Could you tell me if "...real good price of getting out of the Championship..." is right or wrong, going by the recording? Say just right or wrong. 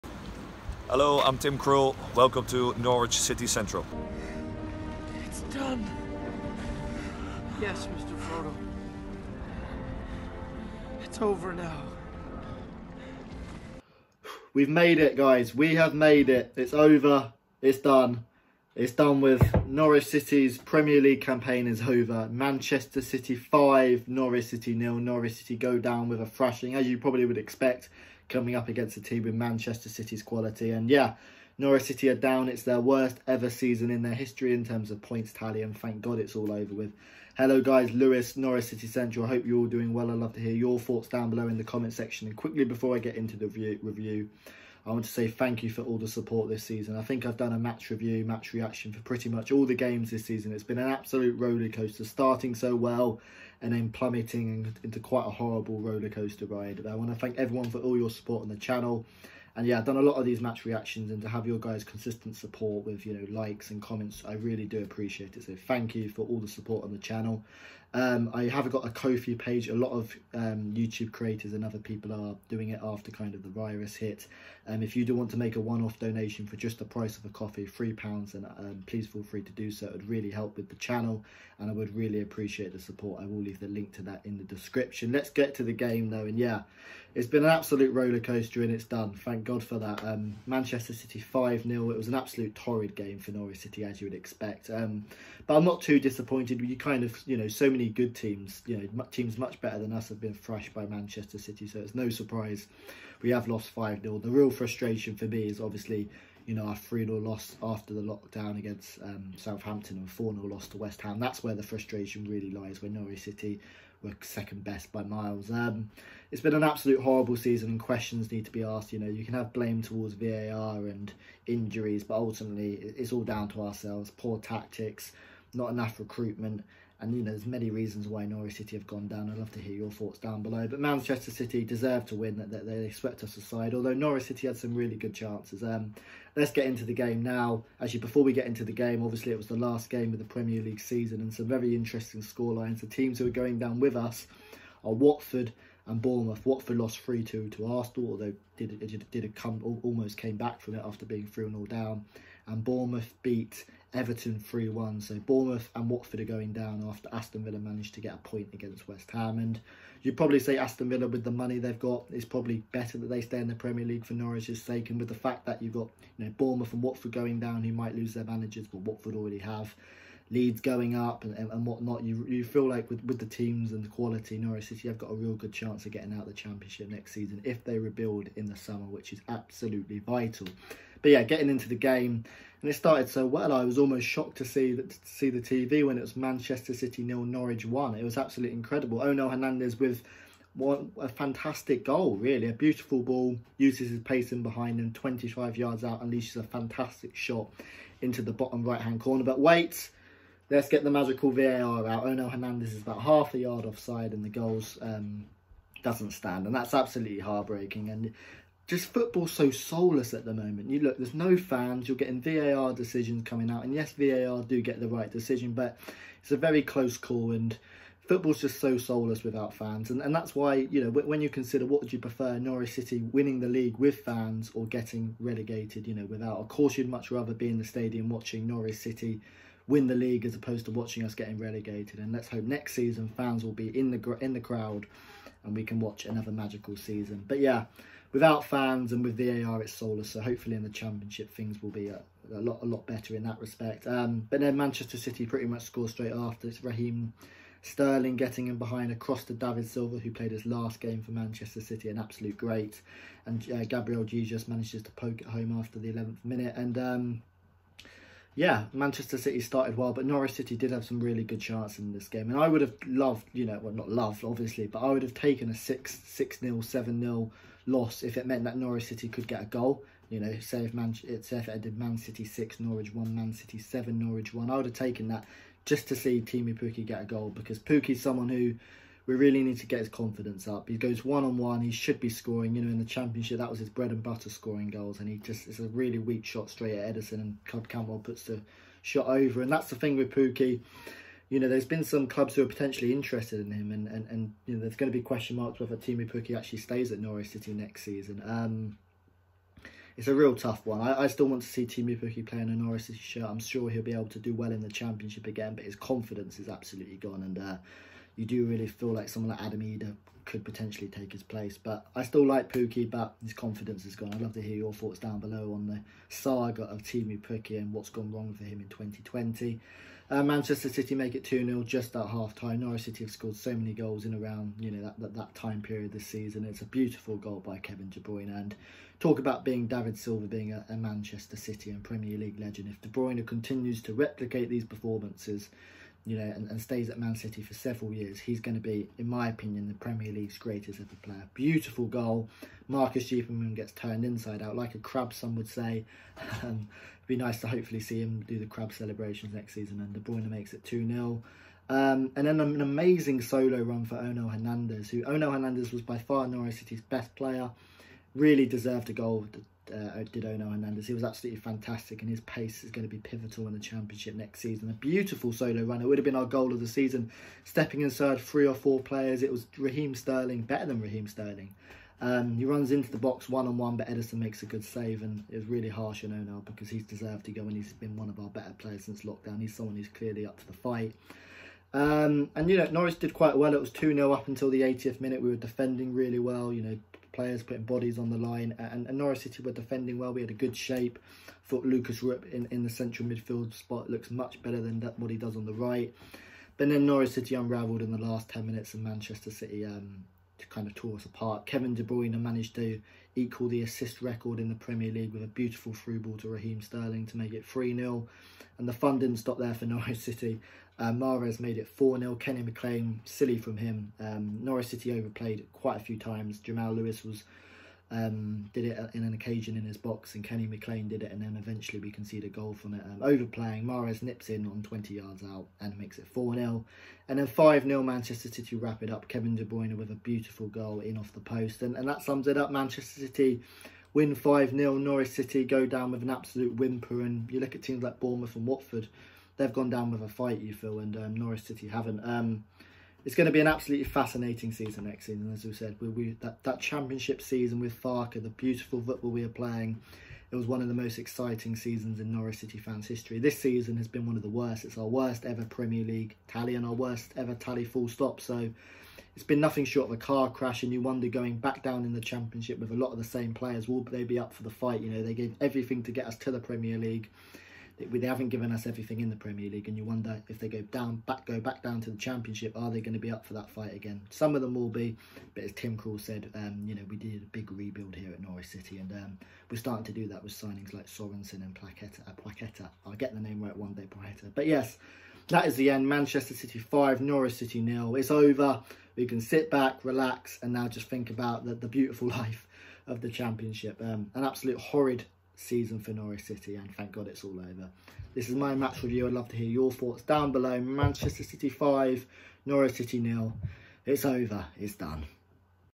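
wrong.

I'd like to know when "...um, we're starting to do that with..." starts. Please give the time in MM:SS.
07:58.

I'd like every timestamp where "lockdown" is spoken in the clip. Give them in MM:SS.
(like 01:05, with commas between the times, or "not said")
01:48, 06:19.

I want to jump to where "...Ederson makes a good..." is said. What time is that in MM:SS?
06:13.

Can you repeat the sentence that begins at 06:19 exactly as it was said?
He's someone who's clearly up to the fight.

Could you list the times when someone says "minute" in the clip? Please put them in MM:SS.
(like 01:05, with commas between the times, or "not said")
04:16, 06:24, 06:38.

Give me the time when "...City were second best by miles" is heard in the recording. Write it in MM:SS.
01:53.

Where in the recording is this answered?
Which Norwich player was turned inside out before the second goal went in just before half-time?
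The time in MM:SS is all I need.
05:42.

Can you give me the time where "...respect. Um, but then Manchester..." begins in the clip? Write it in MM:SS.
04:03.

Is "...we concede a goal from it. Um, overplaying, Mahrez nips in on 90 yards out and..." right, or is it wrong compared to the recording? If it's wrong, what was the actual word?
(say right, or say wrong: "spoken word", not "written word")
wrong: "20", not "90".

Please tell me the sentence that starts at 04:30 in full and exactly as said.
You know, say if, Man- say if it did Man City 6, Norwich 1, Man City 7, Norwich 1.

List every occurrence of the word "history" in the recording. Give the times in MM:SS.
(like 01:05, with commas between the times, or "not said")
00:34, 07:32.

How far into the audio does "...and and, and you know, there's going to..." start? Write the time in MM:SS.
04:53.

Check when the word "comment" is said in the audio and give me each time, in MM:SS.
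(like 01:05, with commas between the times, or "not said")
00:41, 01:03.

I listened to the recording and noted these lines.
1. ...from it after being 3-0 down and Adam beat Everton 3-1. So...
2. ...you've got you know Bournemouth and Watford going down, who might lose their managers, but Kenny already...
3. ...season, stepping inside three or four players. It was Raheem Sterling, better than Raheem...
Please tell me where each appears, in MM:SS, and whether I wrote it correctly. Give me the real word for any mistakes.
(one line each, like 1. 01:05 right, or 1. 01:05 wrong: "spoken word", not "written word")
1. 02:30 wrong: "Bournemouth", not "Adam"
2. 02:45 wrong: "Watford", not "Kenny"
3. 06:06 right.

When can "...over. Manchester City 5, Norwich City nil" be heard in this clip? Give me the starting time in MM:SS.
00:21.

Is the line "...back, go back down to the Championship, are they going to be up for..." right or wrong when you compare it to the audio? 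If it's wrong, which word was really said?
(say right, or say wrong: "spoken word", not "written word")
right.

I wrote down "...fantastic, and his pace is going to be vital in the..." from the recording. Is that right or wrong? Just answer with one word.
wrong.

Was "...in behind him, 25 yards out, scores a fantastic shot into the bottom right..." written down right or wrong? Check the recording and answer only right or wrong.
wrong.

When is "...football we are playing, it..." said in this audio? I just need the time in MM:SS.
07:28.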